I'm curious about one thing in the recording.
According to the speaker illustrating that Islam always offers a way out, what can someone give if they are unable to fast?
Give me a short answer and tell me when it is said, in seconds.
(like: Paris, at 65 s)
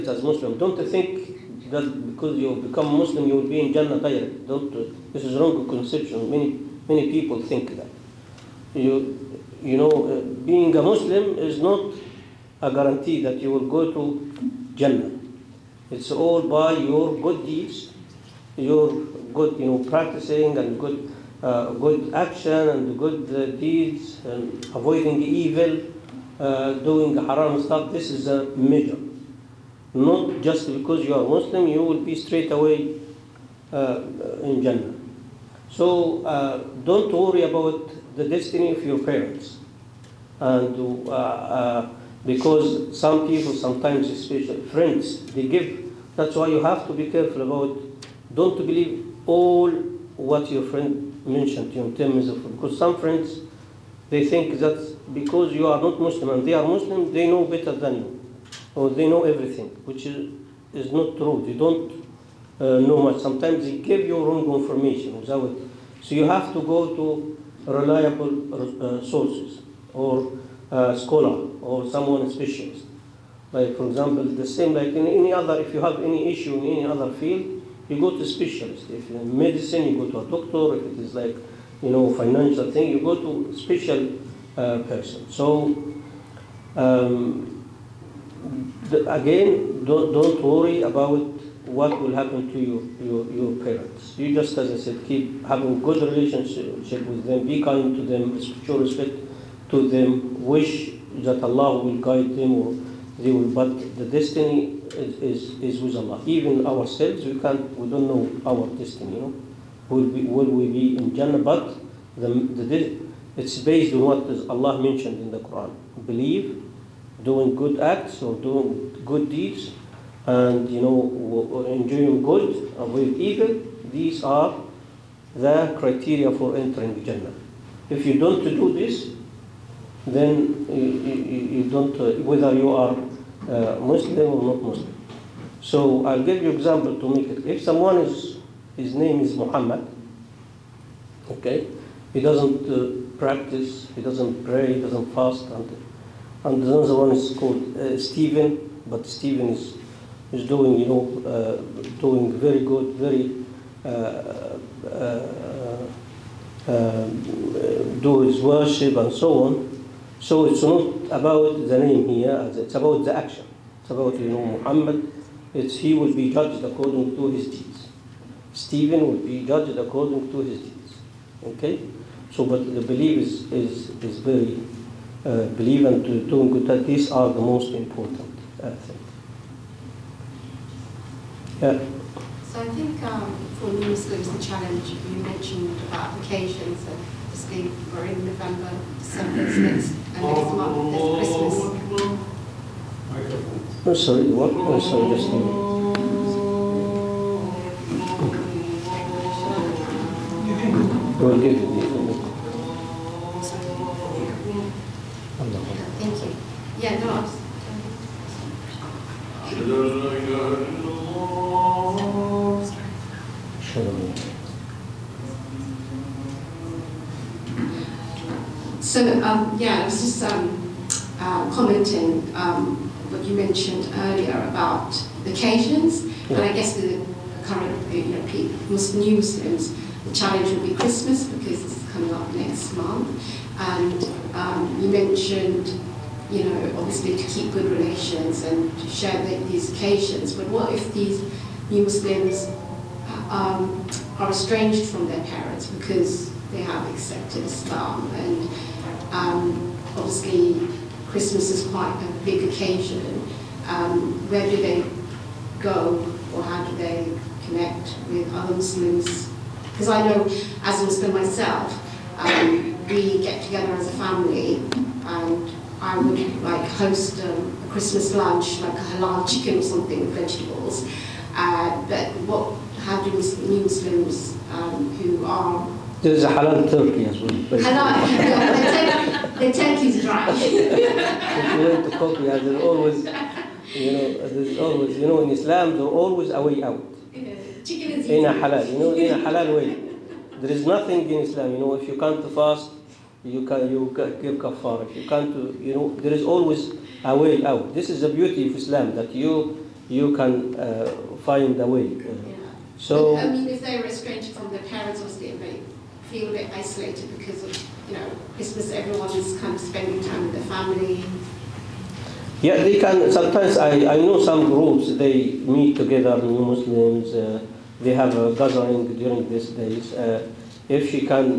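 kafara, at 294 s.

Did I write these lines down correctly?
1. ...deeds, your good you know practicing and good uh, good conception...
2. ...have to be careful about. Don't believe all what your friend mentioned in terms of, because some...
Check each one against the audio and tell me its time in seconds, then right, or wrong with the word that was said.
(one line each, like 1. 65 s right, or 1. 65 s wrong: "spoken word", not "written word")
1. 17 s wrong: "action", not "conception"
2. 46 s right.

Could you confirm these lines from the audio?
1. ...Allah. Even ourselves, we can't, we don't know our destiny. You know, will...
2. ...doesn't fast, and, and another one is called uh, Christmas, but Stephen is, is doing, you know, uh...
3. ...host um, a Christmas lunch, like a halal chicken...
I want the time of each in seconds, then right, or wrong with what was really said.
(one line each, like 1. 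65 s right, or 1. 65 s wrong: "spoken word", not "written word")
1. 105 s right
2. 144 s wrong: "Stephen", not "Christmas"
3. 266 s right.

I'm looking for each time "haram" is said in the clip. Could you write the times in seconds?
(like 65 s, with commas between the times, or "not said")
27 s.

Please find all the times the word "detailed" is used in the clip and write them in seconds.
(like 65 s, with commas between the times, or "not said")
not said.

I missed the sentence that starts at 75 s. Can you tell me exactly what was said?
If you have any issue in any other field, you go to specialist.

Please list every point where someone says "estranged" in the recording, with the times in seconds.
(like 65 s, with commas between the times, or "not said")
244 s, 303 s.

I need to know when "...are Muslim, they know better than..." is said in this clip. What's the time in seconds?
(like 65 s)
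56 s.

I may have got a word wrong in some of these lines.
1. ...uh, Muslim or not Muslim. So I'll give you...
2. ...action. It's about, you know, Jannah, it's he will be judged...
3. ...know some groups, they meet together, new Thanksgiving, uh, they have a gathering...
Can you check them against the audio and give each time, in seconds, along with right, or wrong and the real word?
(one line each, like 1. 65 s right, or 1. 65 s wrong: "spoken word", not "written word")
1. 133 s right
2. 163 s wrong: "Muhammad", not "Jannah"
3. 313 s wrong: "Muslims", not "Thanksgiving".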